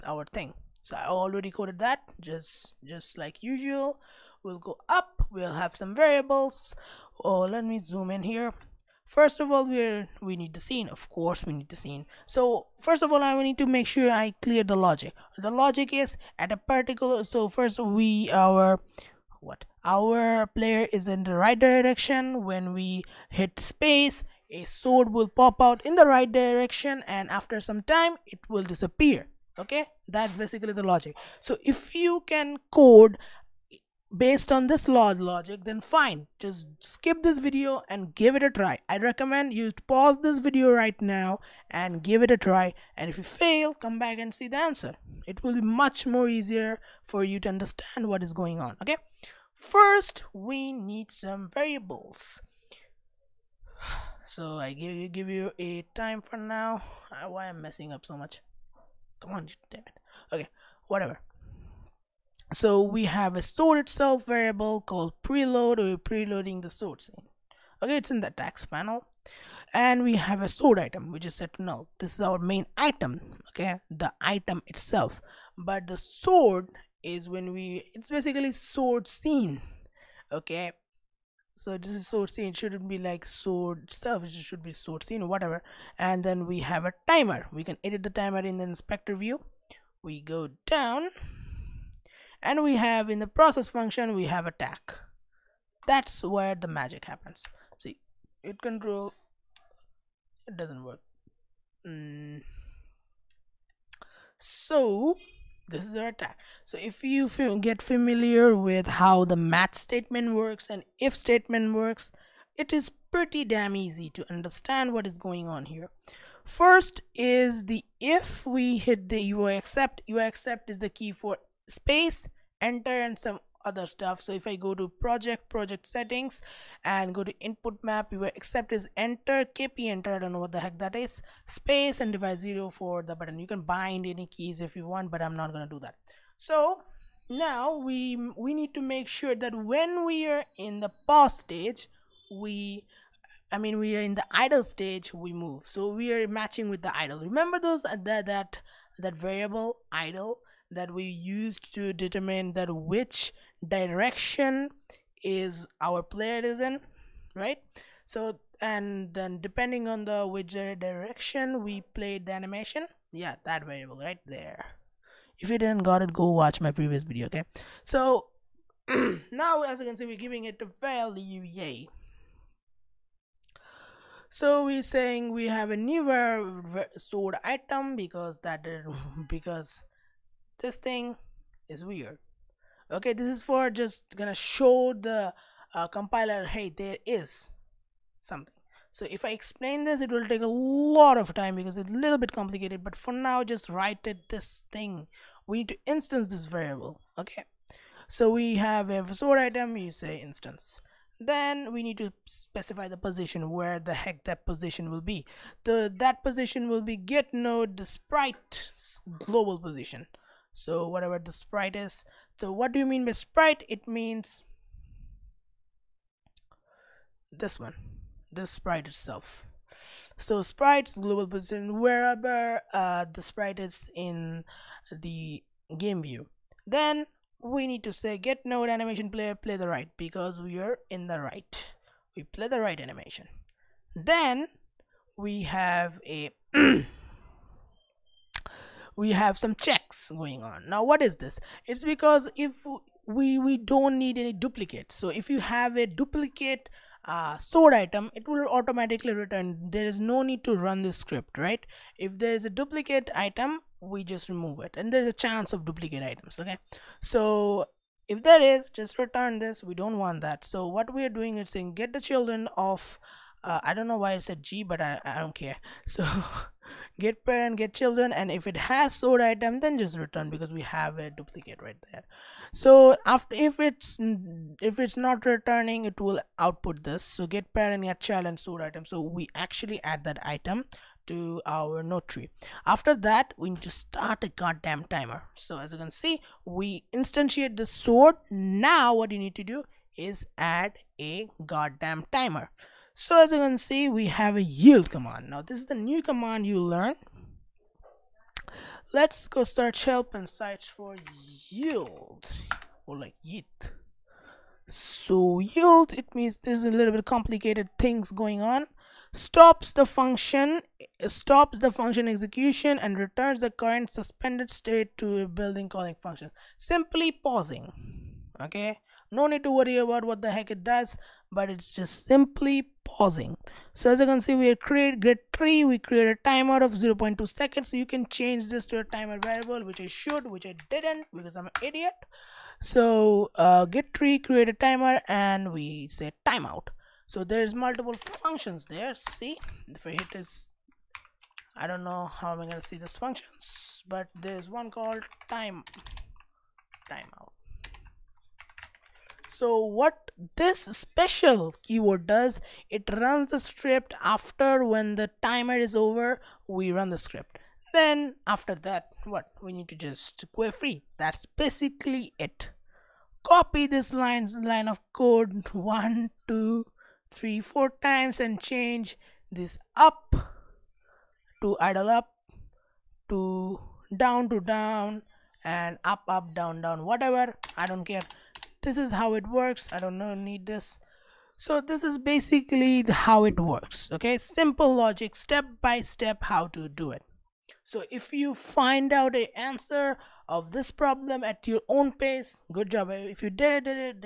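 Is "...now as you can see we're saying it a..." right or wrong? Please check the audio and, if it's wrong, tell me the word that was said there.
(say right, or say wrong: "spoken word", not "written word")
wrong: "giving", not "saying".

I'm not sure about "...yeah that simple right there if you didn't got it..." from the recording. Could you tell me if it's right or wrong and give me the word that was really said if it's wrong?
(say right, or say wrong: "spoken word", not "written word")
wrong: "variable", not "simple".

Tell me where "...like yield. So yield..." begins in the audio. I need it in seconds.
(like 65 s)
302 s.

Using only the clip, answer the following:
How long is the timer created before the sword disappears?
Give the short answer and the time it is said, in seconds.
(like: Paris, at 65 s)
0.2 seconds, at 326 s.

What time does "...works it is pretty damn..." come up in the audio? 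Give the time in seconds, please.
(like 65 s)
111 s.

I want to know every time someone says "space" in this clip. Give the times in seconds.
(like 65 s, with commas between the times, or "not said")
23 s, 121 s, 131 s.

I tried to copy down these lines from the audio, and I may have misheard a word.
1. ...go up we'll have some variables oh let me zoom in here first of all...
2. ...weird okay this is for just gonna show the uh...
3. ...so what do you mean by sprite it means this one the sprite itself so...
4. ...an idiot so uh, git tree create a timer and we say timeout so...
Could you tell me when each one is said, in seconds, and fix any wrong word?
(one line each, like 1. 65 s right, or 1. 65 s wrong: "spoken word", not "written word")
1. 4 s right
2. 181 s right
3. 212 s right
4. 331 s right.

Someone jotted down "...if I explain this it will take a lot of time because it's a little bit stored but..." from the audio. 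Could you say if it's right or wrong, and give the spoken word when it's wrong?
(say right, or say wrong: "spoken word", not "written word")
wrong: "complicated", not "stored".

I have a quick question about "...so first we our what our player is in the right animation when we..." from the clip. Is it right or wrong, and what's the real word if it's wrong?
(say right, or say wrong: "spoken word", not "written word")
wrong: "direction", not "animation".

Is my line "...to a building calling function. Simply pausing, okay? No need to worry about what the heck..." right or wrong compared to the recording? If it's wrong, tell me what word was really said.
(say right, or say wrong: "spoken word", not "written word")
right.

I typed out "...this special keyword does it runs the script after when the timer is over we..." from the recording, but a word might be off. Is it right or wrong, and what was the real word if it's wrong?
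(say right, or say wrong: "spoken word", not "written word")
right.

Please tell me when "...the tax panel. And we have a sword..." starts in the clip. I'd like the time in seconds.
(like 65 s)
68 s.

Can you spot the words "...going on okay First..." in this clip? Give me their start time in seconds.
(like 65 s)
48 s.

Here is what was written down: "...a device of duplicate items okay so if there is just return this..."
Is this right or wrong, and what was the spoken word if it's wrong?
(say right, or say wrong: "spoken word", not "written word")
wrong: "chance", not "device".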